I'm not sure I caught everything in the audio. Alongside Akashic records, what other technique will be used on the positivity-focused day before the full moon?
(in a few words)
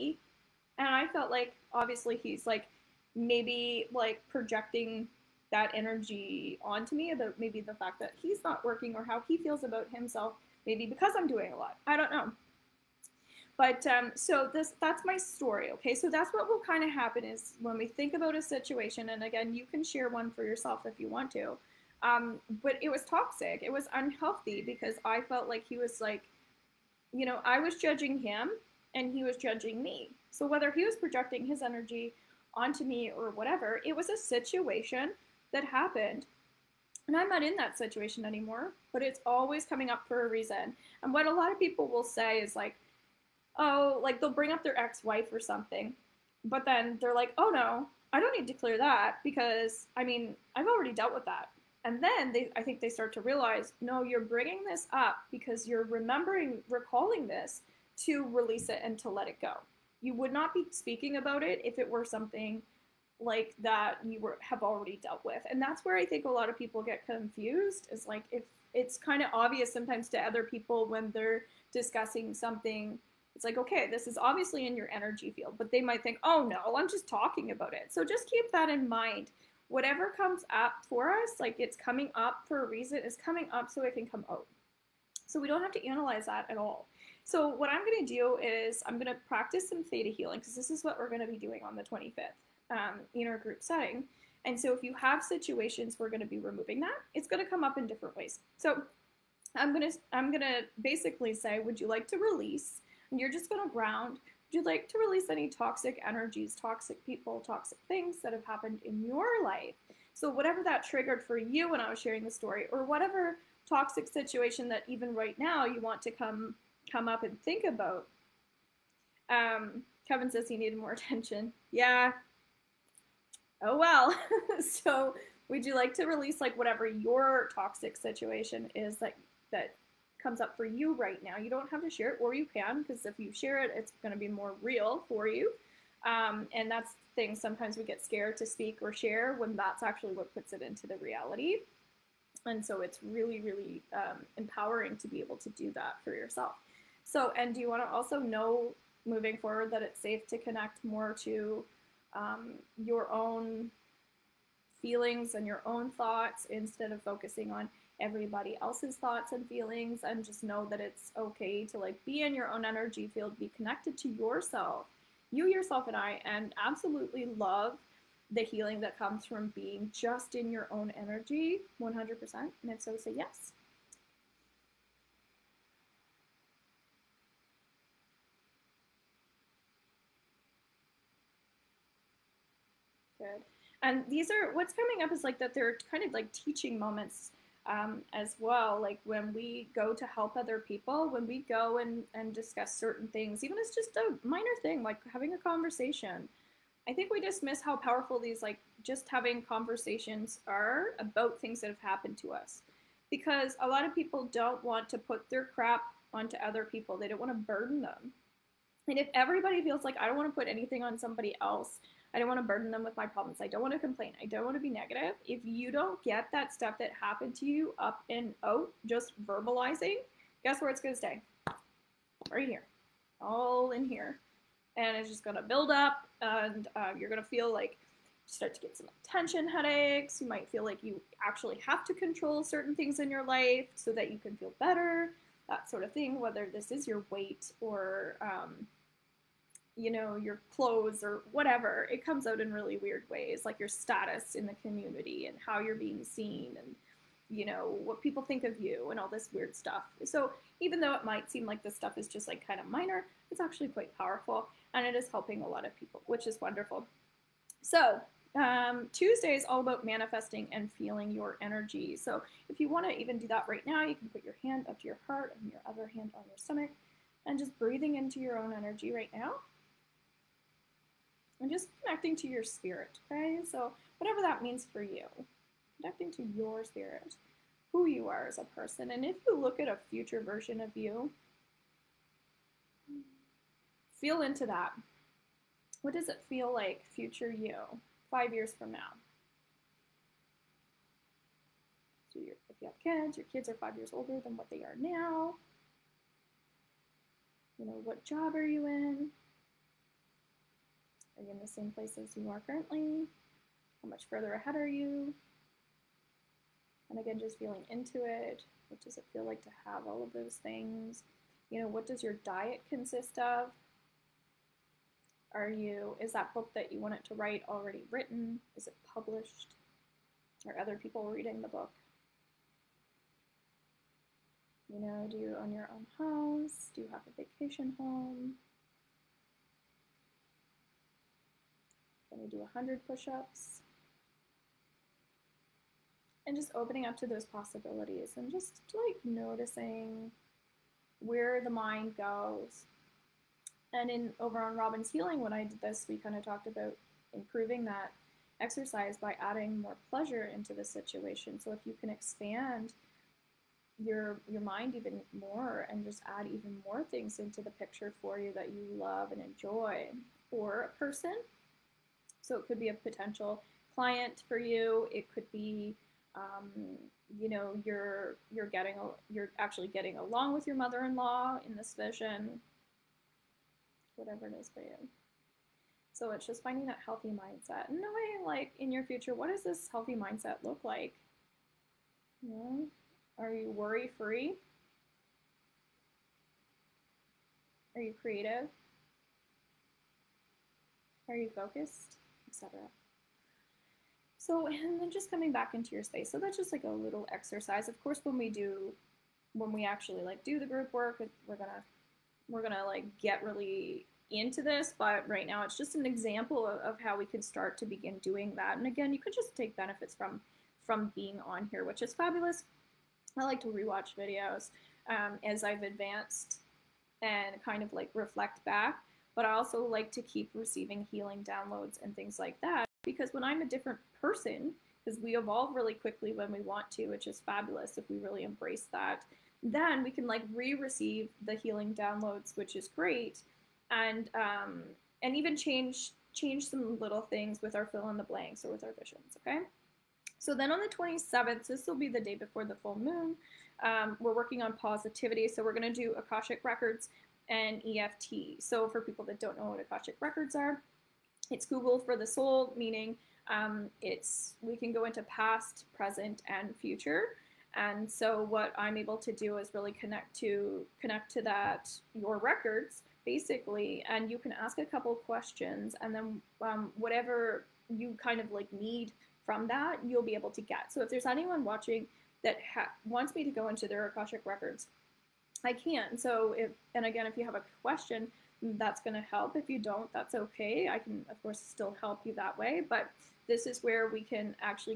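EFT.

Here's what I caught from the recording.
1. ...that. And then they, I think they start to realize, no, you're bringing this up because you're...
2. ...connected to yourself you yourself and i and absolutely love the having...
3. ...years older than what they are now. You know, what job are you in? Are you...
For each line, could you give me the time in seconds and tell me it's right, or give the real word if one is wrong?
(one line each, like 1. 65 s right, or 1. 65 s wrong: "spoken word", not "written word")
1. 51 s right
2. 163 s wrong: "healing", not "having"
3. 293 s right.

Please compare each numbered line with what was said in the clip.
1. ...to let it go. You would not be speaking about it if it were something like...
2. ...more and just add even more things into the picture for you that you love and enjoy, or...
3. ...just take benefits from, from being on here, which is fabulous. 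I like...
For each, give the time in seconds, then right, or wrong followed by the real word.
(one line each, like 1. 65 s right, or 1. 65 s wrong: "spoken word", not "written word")
1. 58 s right
2. 355 s right
3. 409 s right.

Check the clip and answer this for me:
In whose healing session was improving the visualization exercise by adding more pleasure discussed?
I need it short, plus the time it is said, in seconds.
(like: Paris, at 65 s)
Robin's Healing, at 344 s.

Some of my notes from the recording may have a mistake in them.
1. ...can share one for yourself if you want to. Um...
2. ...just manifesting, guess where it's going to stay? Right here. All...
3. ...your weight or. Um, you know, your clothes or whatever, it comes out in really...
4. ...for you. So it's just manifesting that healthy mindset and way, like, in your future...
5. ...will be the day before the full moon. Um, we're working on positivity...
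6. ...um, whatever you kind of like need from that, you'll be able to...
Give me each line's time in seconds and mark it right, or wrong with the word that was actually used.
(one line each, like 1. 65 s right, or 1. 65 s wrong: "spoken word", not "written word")
1. 19 s right
2. 218 s wrong: "verbalizing", not "manifesting"
3. 236 s right
4. 374 s wrong: "finding", not "manifesting"
5. 441 s right
6. 466 s right.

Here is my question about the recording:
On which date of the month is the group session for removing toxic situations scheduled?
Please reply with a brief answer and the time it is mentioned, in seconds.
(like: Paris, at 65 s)
25th, at 91 s.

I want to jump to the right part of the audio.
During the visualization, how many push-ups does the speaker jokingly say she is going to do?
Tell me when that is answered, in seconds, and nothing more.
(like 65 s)
332 s.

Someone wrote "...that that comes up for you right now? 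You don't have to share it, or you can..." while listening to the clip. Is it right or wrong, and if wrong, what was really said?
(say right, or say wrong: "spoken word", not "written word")
right.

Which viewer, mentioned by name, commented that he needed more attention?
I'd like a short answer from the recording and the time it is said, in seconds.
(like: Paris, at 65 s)
Kevin, at 120 s.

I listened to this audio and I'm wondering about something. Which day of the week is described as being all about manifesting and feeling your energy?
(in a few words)
Tuesday.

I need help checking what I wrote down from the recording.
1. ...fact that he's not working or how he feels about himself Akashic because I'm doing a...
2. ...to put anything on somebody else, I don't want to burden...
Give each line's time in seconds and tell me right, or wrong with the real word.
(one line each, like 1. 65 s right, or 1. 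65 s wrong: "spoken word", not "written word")
1. 7 s wrong: "Maybe", not "Akashic"
2. 210 s right.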